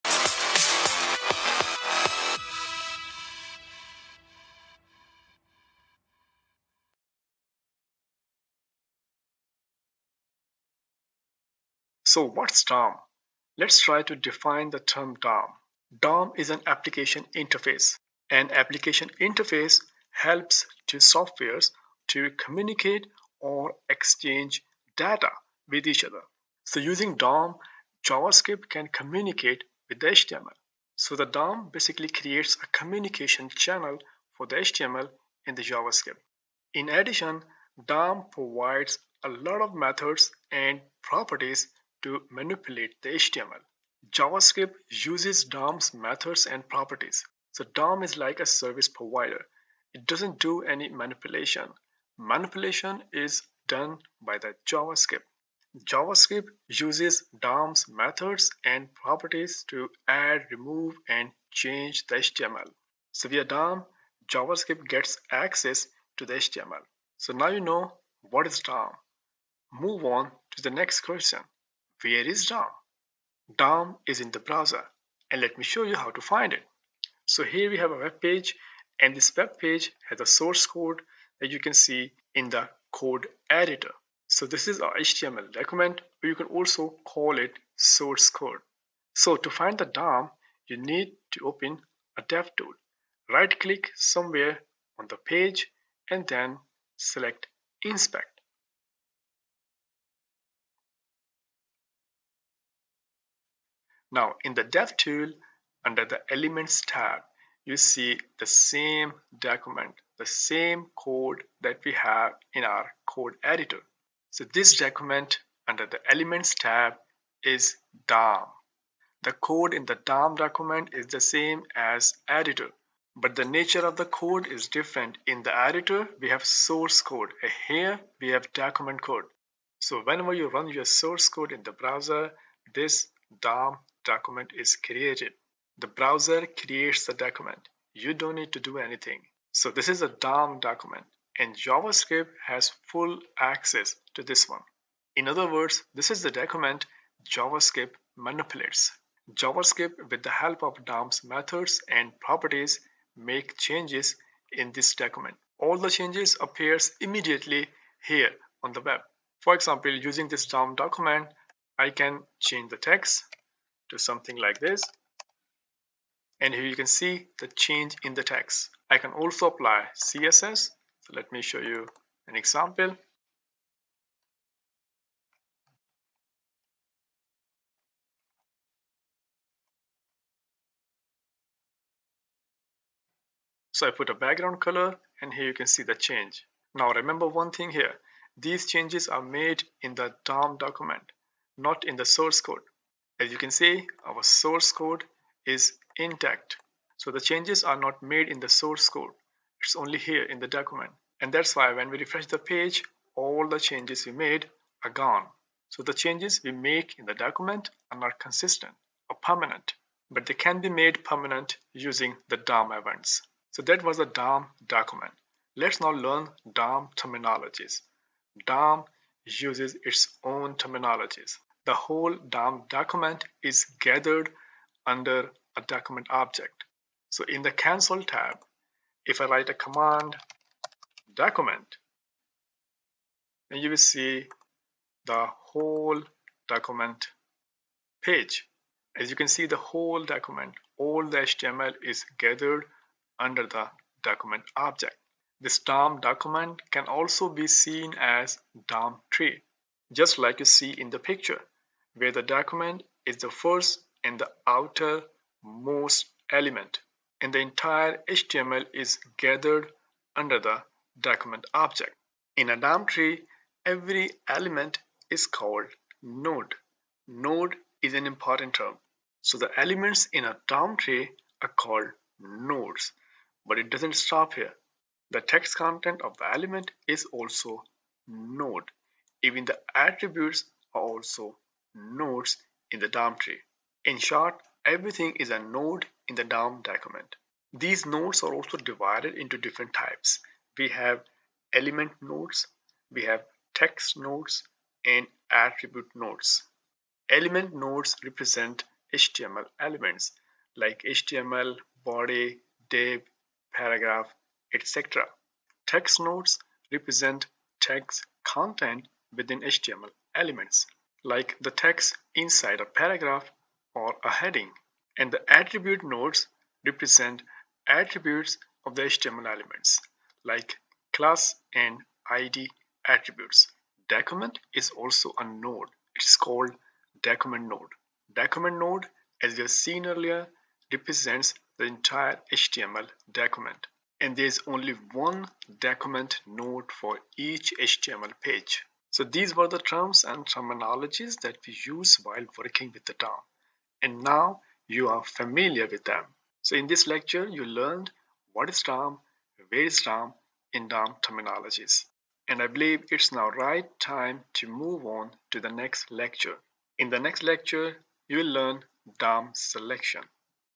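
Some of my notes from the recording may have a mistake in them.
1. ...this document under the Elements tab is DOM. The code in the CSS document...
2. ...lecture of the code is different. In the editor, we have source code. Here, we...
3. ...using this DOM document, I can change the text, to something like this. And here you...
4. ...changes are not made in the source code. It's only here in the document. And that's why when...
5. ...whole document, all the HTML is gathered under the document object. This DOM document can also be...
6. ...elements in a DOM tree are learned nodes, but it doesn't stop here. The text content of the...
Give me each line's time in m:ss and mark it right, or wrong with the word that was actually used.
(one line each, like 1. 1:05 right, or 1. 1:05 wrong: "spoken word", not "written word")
1. 1:54 wrong: "DOM", not "CSS"
2. 2:03 wrong: "nature", not "lecture"
3. 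2:39 right
4. 3:17 right
5. 3:59 right
6. 4:29 wrong: "called", not "learned".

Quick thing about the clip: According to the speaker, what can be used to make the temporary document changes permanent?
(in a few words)
DOM events.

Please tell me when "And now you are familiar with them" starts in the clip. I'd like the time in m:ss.
5:43.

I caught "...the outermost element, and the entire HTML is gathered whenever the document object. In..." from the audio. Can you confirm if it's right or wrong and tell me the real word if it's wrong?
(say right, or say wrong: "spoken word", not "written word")
wrong: "under", not "whenever".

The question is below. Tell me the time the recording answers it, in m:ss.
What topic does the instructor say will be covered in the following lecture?
5:58.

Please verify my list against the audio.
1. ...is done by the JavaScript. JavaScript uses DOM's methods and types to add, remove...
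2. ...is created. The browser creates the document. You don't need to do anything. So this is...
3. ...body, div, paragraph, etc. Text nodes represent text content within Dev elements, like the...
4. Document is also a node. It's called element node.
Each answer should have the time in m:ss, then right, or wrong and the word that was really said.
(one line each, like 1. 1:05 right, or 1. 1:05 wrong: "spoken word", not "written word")
1. 0:53 wrong: "properties", not "types"
2. 2:14 right
3. 5:01 wrong: "HTML", not "Dev"
4. 5:23 wrong: "document", not "element".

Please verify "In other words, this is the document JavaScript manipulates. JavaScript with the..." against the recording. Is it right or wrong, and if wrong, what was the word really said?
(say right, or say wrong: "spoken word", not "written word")
right.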